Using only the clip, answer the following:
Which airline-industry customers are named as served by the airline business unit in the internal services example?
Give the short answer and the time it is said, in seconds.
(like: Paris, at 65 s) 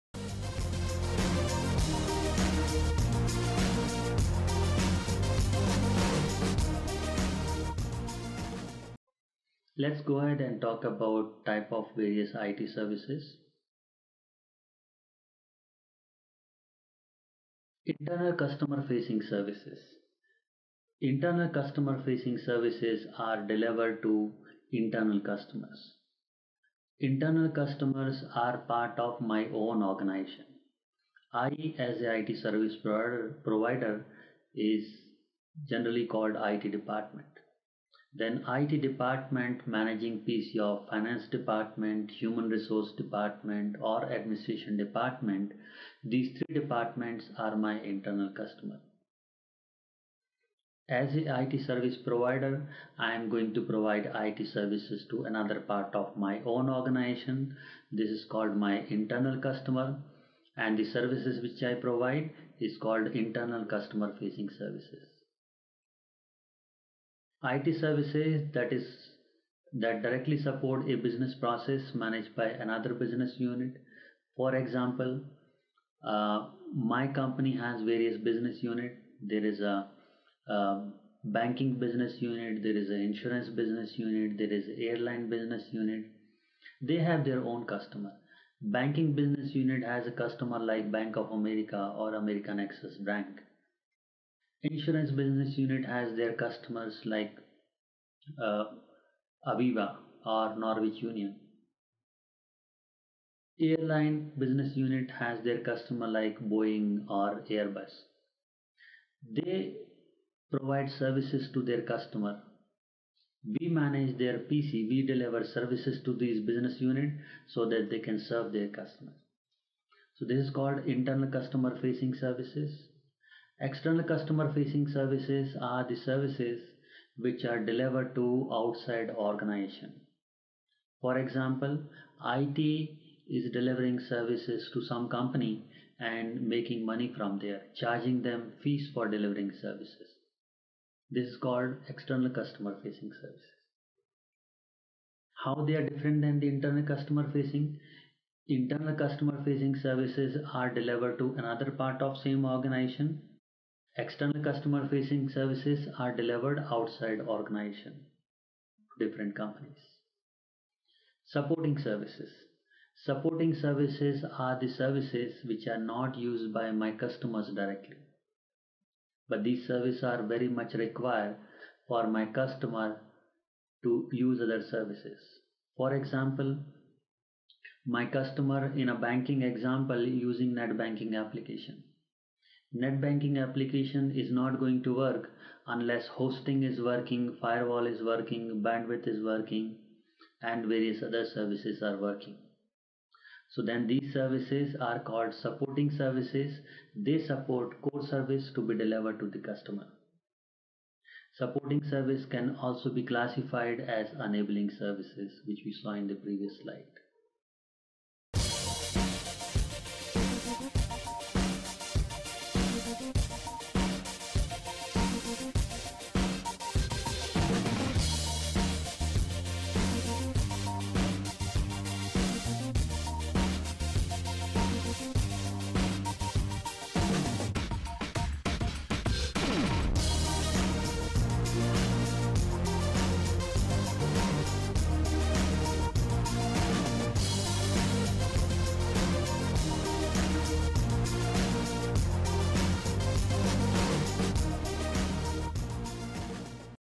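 Boeing or Airbus, at 106 s.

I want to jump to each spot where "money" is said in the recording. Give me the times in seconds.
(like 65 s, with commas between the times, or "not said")
136 s.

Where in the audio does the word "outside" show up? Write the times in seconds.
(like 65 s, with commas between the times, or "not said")
128 s, 156 s.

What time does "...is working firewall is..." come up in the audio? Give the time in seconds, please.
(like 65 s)
186 s.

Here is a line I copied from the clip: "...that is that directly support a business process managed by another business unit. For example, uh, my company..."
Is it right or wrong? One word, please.
right.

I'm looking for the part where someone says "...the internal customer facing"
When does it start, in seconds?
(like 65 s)
146 s.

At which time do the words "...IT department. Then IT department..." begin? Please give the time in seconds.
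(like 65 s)
36 s.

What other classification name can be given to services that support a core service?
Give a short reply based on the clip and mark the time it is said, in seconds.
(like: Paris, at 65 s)
Enabling services, at 204 s.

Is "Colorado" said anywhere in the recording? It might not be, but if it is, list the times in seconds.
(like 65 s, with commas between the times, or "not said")
not said.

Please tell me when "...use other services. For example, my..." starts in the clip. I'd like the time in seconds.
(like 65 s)
174 s.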